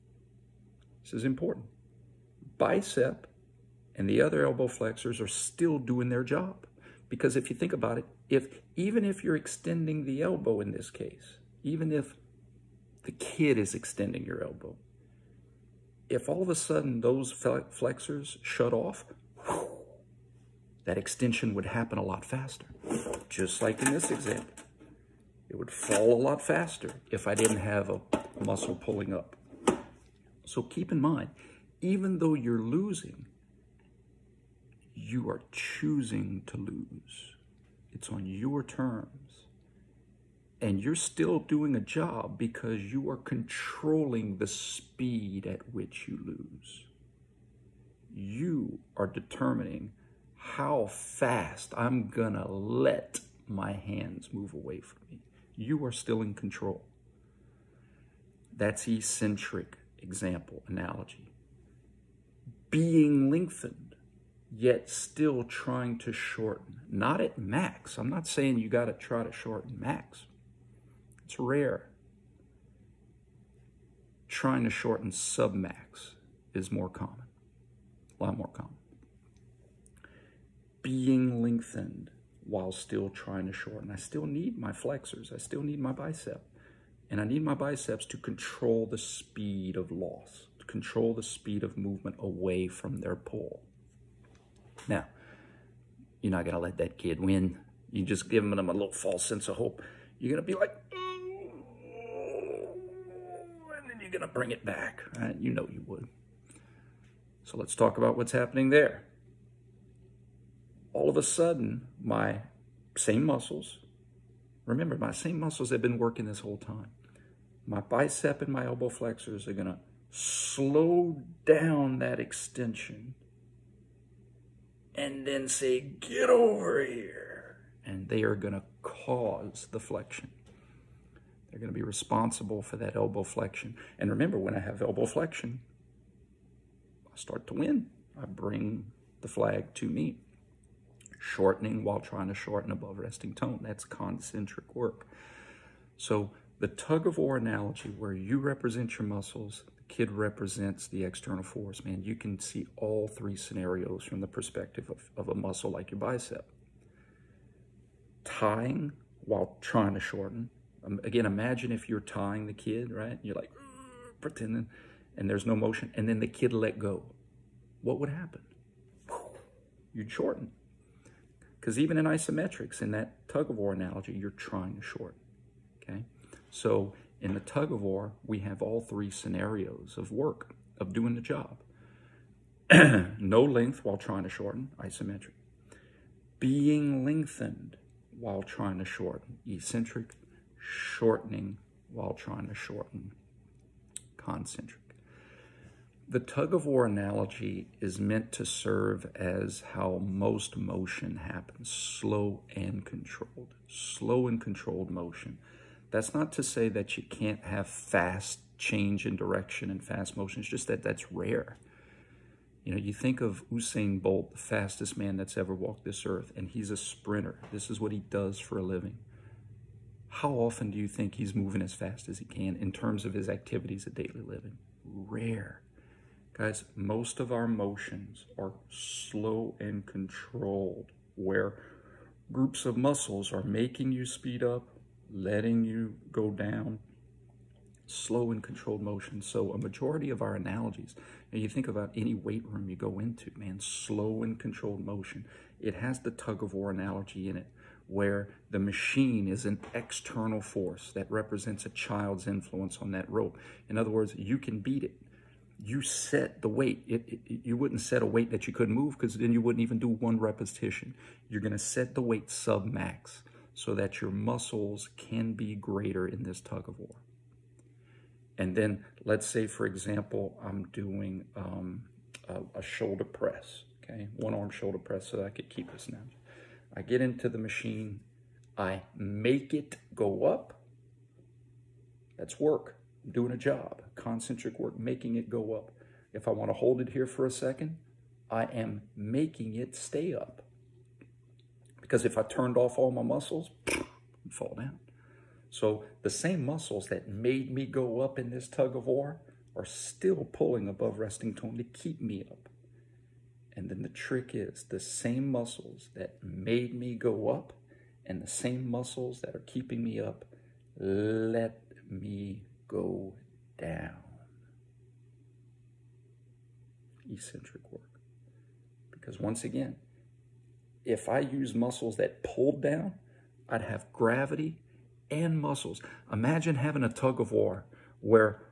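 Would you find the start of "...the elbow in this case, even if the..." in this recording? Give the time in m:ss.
0:10.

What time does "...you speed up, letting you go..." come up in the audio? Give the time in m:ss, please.
3:53.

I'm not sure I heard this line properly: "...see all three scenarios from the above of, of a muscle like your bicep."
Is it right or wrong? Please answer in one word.
wrong.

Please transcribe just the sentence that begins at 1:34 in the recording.
Now, you're not going to let that kid win.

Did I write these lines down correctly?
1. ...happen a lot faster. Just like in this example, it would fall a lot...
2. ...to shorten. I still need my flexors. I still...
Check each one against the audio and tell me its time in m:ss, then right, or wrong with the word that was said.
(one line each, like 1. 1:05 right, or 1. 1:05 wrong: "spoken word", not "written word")
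1. 0:21 right
2. 1:23 right.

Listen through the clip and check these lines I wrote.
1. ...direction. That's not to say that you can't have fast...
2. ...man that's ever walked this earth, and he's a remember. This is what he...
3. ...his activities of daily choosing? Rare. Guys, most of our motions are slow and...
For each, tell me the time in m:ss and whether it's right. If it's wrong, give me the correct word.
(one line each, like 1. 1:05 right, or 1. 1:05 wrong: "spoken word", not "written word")
1. 3:24 wrong: "motion", not "direction"
2. 3:34 wrong: "sprinter", not "remember"
3. 3:43 wrong: "living", not "choosing".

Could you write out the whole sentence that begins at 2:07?
And they are going to cause the flexion.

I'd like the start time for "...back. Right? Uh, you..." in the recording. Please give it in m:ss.
1:44.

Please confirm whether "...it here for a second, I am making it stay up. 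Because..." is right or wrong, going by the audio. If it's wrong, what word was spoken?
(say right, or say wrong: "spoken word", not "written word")
right.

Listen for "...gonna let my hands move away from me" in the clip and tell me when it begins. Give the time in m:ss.
0:52.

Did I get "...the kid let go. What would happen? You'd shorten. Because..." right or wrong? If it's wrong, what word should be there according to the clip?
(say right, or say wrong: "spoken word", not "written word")
right.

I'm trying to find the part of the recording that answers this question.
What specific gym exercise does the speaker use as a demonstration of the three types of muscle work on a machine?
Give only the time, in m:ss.
4:34.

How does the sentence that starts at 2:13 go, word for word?
And remember, when I have elbow flexion, I start to win.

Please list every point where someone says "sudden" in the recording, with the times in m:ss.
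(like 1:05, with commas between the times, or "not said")
0:16, 1:51.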